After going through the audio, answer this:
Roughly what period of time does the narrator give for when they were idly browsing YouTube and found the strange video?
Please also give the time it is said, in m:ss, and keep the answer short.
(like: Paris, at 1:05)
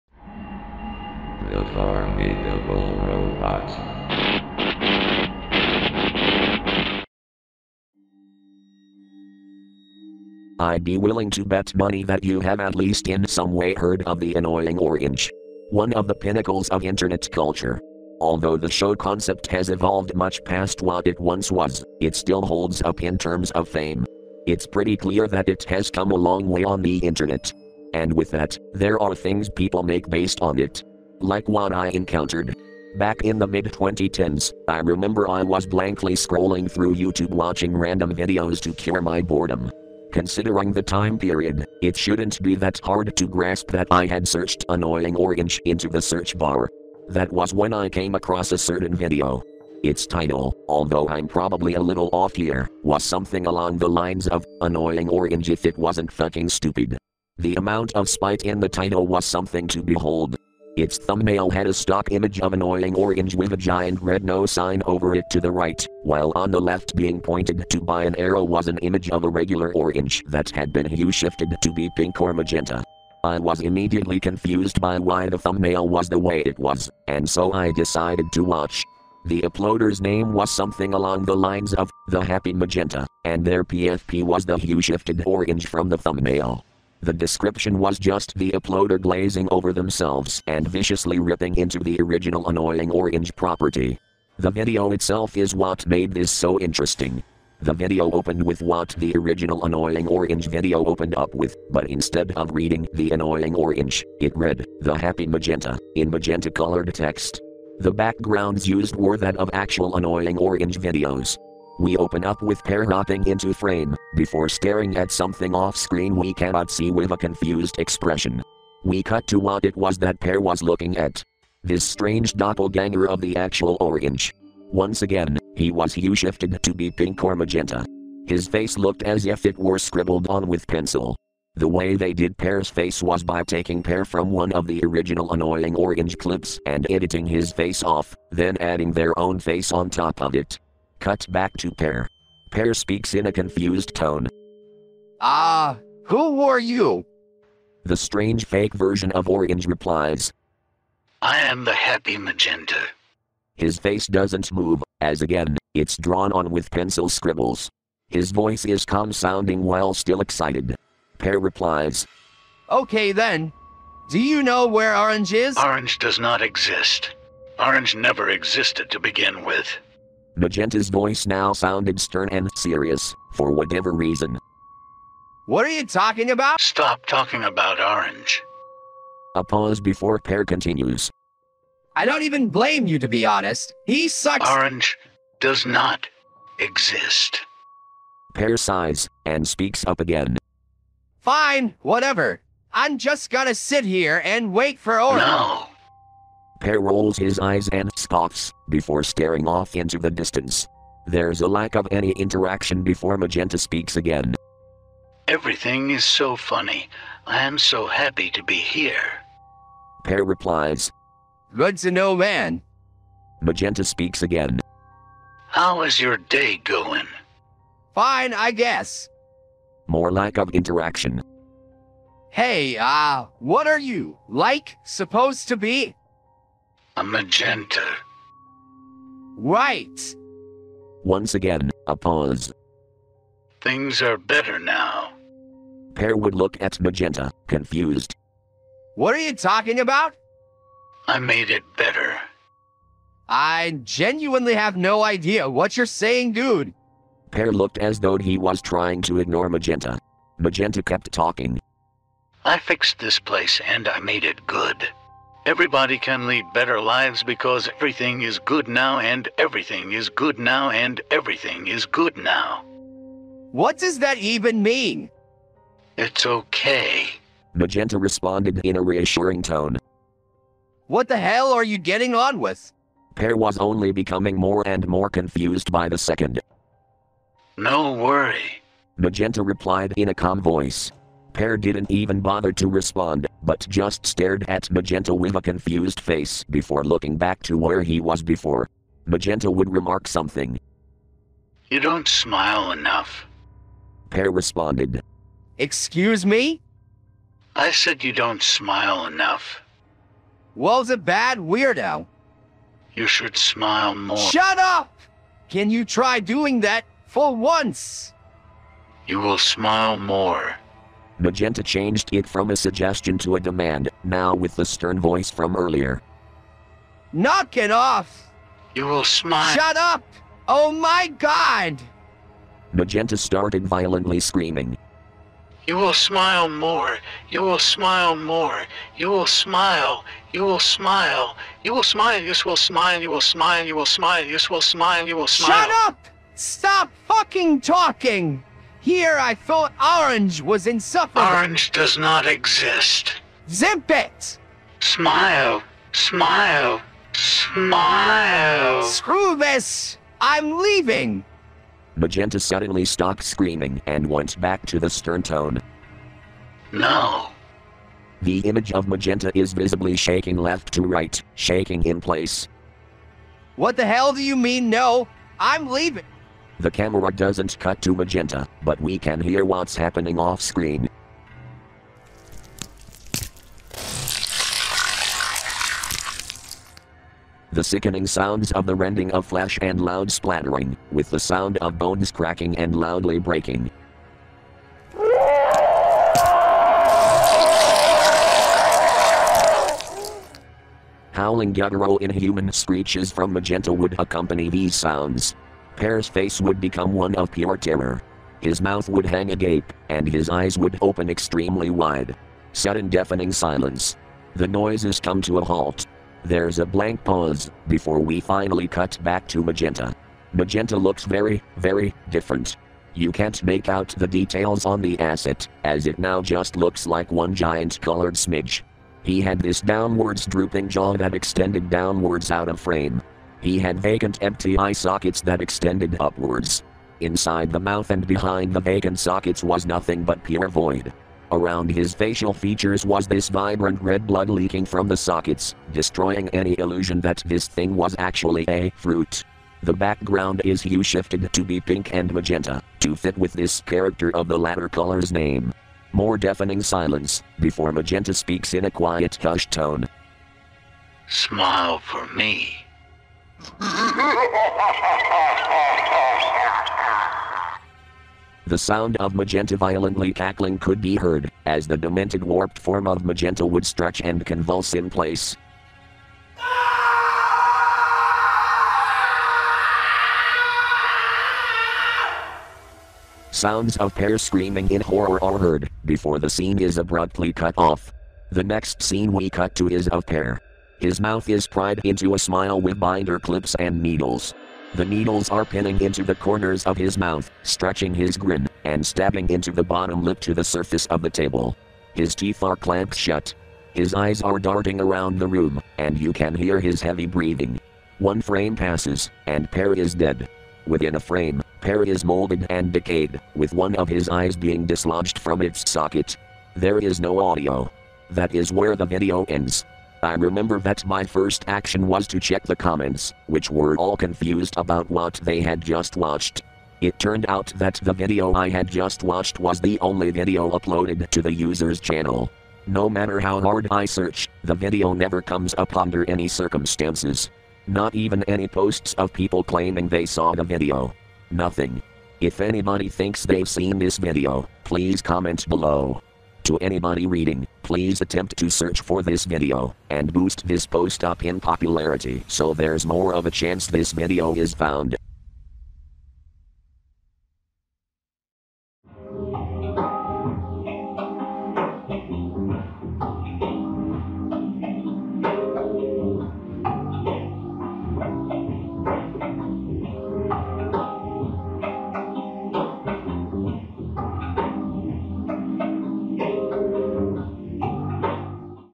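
mid 2010s, at 0:33.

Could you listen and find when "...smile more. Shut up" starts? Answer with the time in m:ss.
5:03.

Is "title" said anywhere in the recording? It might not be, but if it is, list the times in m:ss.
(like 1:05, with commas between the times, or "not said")
0:50, 0:58.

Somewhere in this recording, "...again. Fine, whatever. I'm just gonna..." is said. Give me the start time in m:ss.
3:09.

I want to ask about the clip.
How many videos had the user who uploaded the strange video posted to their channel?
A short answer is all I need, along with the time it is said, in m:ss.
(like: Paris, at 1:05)
1, at 8:39.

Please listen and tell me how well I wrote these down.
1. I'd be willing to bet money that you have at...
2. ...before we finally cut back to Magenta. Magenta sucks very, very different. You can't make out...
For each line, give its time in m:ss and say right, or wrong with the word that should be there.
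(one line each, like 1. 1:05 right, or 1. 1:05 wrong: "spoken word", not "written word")
1. 0:10 right
2. 6:47 wrong: "looks", not "sucks".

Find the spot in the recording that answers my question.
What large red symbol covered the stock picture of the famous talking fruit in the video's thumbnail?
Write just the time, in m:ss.
1:04.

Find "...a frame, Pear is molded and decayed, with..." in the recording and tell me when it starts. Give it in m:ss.
8:20.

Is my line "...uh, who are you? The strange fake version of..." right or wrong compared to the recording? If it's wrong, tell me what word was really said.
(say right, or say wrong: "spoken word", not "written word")
right.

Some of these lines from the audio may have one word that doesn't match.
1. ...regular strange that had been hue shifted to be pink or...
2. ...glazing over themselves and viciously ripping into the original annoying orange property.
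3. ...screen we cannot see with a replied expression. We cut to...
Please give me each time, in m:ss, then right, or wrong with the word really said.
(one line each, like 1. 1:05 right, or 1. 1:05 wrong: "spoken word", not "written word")
1. 1:09 wrong: "orange", not "strange"
2. 1:29 right
3. 1:55 wrong: "confused", not "replied".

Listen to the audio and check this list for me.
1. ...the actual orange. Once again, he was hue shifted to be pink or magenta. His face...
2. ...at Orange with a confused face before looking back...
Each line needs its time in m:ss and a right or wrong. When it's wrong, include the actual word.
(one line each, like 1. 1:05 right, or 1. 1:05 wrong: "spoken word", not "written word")
1. 2:03 right
2. 4:44 wrong: "Magenta", not "Orange".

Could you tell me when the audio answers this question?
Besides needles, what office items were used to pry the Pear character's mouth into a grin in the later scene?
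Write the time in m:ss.
8:02.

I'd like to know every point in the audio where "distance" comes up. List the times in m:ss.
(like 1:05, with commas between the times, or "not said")
3:20.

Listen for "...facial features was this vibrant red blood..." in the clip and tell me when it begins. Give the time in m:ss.
7:11.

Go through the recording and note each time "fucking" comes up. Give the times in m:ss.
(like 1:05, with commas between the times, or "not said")
0:56, 5:37.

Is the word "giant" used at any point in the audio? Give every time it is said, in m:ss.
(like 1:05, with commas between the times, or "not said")
1:03, 6:57.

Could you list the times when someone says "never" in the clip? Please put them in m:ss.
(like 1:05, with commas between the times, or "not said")
2:47, 8:44.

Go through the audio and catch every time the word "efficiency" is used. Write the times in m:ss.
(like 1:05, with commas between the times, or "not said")
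not said.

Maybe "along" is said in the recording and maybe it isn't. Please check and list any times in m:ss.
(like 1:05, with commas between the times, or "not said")
0:53, 1:20.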